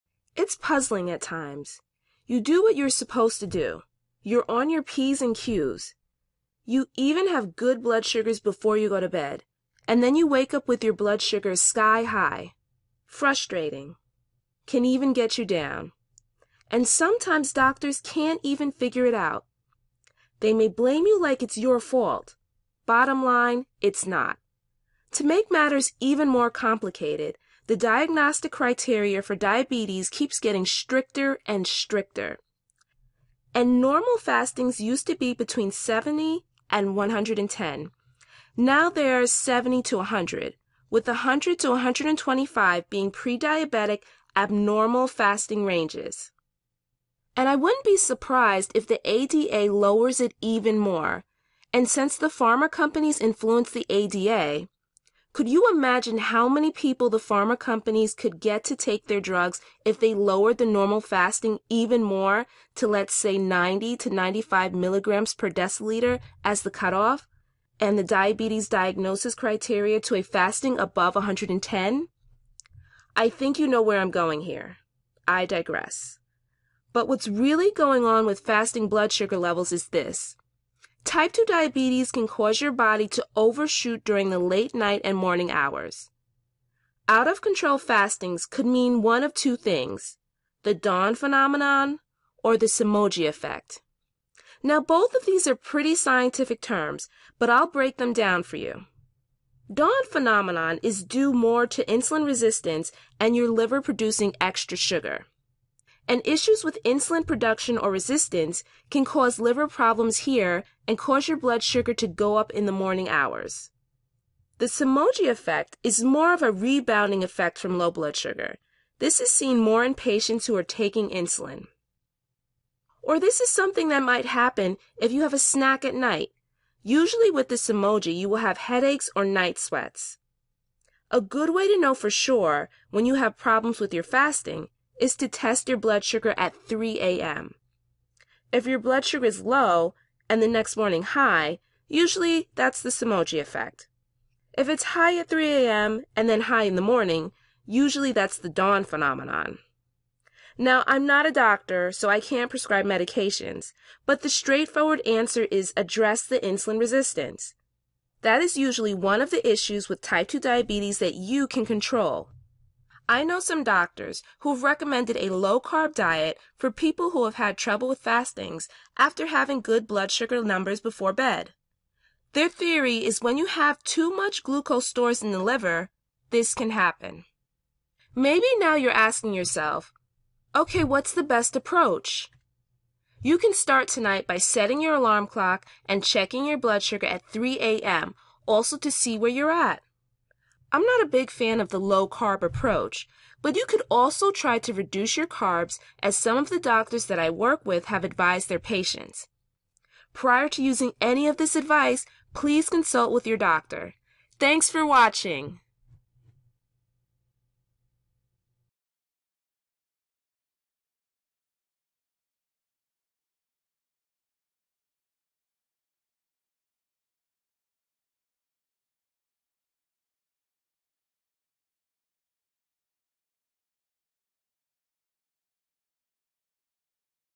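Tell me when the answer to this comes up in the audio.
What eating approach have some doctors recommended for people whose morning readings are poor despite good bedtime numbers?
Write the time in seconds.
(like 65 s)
165 s.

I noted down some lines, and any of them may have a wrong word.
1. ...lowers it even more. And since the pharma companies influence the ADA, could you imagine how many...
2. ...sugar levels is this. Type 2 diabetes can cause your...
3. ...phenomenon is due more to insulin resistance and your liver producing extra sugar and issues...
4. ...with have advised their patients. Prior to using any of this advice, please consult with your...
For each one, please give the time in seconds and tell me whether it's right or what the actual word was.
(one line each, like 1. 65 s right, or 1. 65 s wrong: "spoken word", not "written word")
1. 49 s right
2. 79 s right
3. 100 s right
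4. 197 s right.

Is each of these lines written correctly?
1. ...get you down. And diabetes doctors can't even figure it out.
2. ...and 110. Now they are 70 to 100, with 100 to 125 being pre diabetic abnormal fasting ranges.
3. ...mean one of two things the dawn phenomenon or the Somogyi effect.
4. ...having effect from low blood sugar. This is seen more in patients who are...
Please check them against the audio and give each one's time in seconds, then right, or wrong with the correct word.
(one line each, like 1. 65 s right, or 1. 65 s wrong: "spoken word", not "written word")
1. 15 s wrong: "sometimes", not "diabetes"
2. 36 s right
3. 88 s right
4. 116 s wrong: "rebounding", not "having".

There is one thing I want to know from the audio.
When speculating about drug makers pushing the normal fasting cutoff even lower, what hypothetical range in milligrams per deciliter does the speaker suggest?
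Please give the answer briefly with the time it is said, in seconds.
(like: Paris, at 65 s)
90 to 95, at 63 s.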